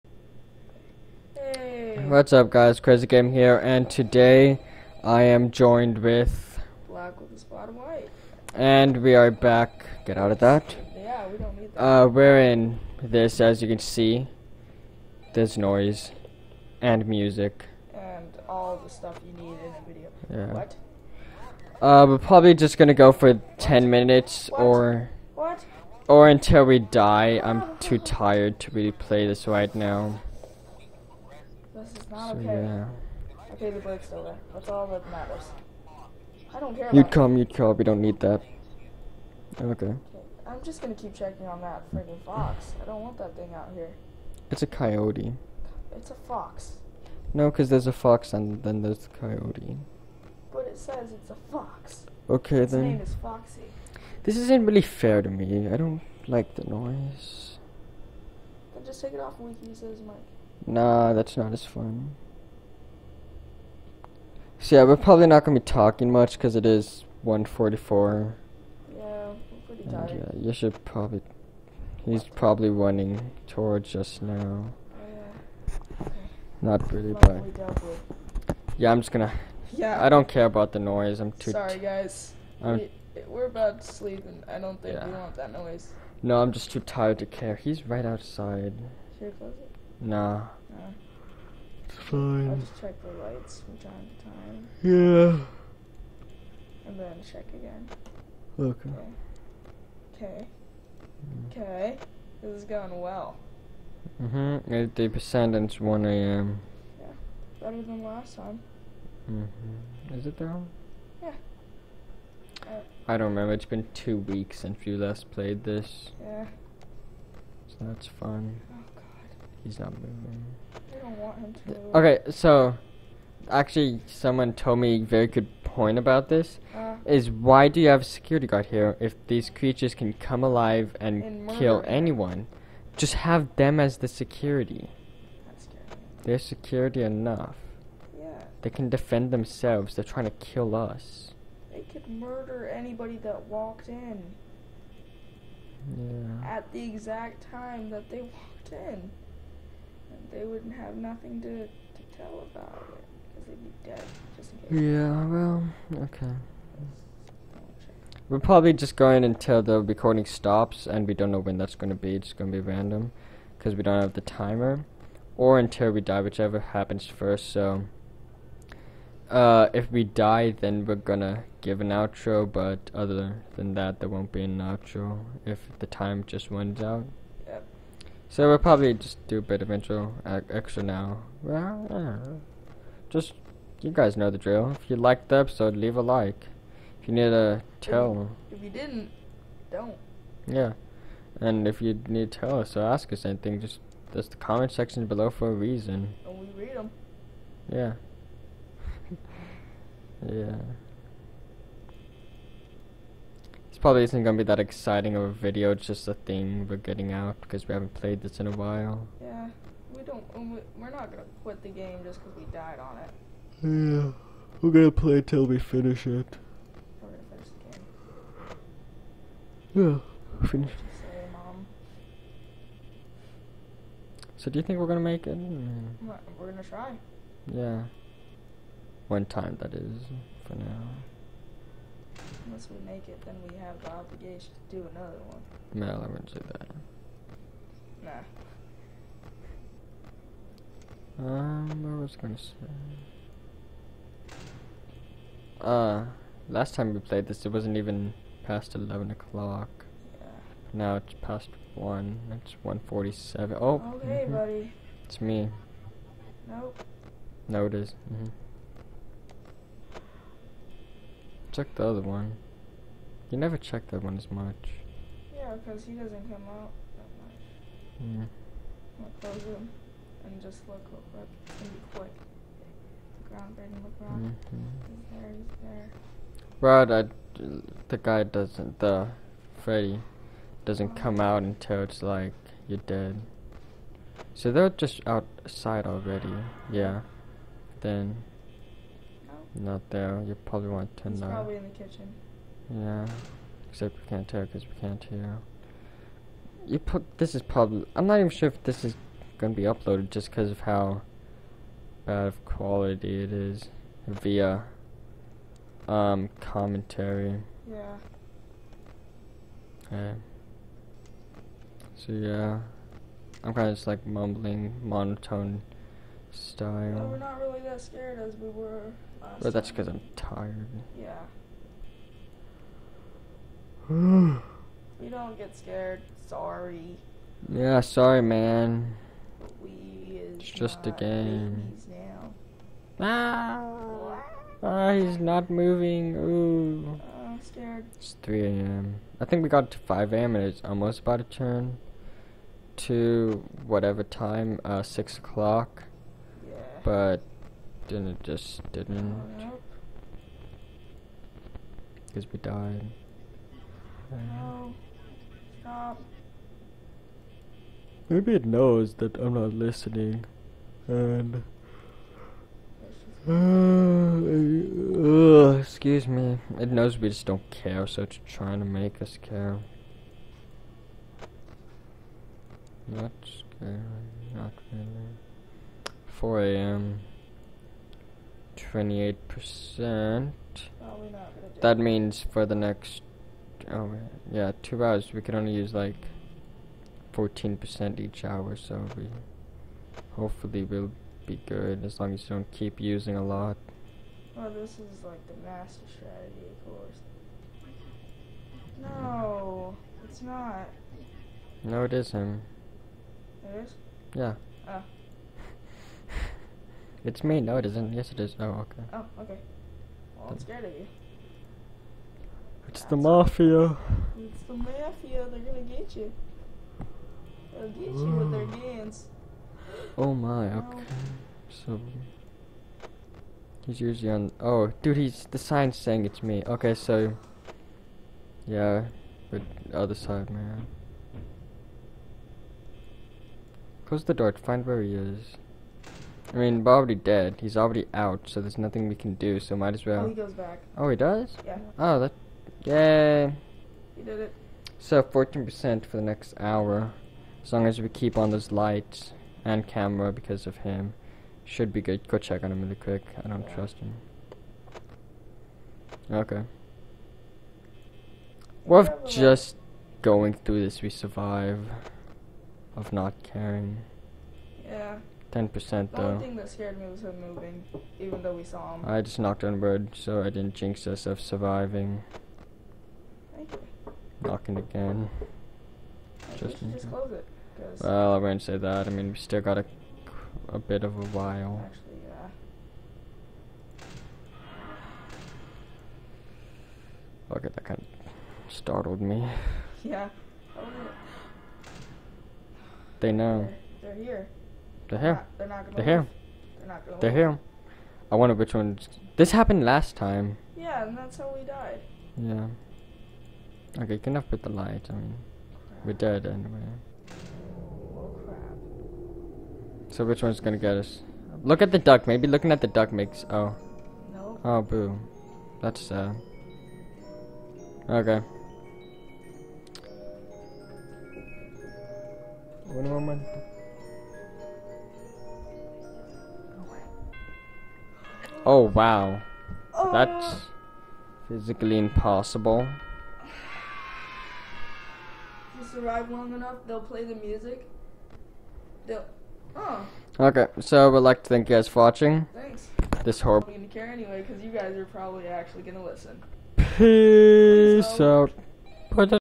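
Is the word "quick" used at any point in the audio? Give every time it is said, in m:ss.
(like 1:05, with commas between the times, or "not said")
4:31, 7:32.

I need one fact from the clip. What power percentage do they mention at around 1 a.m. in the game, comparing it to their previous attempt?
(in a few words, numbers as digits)
80%.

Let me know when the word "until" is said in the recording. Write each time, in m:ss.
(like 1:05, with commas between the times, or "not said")
0:26, 2:39, 2:45, 4:41.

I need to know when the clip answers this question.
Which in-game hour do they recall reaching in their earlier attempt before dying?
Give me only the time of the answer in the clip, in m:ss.
5:39.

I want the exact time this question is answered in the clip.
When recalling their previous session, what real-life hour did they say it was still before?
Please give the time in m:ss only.
4:08.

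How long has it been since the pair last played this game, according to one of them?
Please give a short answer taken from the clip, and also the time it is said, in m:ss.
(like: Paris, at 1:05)
two weeks, at 1:53.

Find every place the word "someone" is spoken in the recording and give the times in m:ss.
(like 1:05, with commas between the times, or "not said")
2:04.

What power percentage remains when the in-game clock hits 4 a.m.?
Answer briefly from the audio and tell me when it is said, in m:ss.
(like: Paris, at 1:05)
28%, at 6:18.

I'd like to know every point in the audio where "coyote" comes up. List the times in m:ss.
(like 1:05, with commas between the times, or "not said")
0:44, 0:49.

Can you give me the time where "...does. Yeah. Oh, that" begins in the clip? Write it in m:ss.
7:20.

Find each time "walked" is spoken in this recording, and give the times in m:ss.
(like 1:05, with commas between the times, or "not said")
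2:23, 2:28.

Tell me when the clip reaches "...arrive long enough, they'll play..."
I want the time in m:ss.
8:55.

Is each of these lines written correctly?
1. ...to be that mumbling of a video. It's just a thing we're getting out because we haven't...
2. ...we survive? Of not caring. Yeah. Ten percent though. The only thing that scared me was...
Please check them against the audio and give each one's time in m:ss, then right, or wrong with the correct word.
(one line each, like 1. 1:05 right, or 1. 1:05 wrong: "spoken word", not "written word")
1. 3:24 wrong: "exciting", not "mumbling"
2. 7:40 right.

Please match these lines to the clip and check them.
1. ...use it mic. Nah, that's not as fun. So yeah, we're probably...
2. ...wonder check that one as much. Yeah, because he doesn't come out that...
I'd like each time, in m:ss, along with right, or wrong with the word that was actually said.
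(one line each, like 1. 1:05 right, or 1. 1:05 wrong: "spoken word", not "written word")
1. 0:59 right
2. 4:23 wrong: "never", not "wonder".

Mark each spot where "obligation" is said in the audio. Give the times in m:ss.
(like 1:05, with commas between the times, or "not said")
3:53.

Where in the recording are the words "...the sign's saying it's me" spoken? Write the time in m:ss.
7:05.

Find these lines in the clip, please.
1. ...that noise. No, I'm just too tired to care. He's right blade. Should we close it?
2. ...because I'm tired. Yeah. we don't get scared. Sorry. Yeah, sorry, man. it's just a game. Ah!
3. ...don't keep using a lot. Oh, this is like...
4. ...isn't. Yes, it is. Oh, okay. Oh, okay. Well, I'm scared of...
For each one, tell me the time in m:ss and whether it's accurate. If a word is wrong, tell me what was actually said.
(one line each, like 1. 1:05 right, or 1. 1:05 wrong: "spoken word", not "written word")
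1. 1:25 wrong: "outside", not "blade"
2. 5:19 right
3. 6:32 right
4. 6:47 right.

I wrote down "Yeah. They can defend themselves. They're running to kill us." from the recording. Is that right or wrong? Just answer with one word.
wrong.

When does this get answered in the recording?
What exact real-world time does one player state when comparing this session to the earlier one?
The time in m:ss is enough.
4:12.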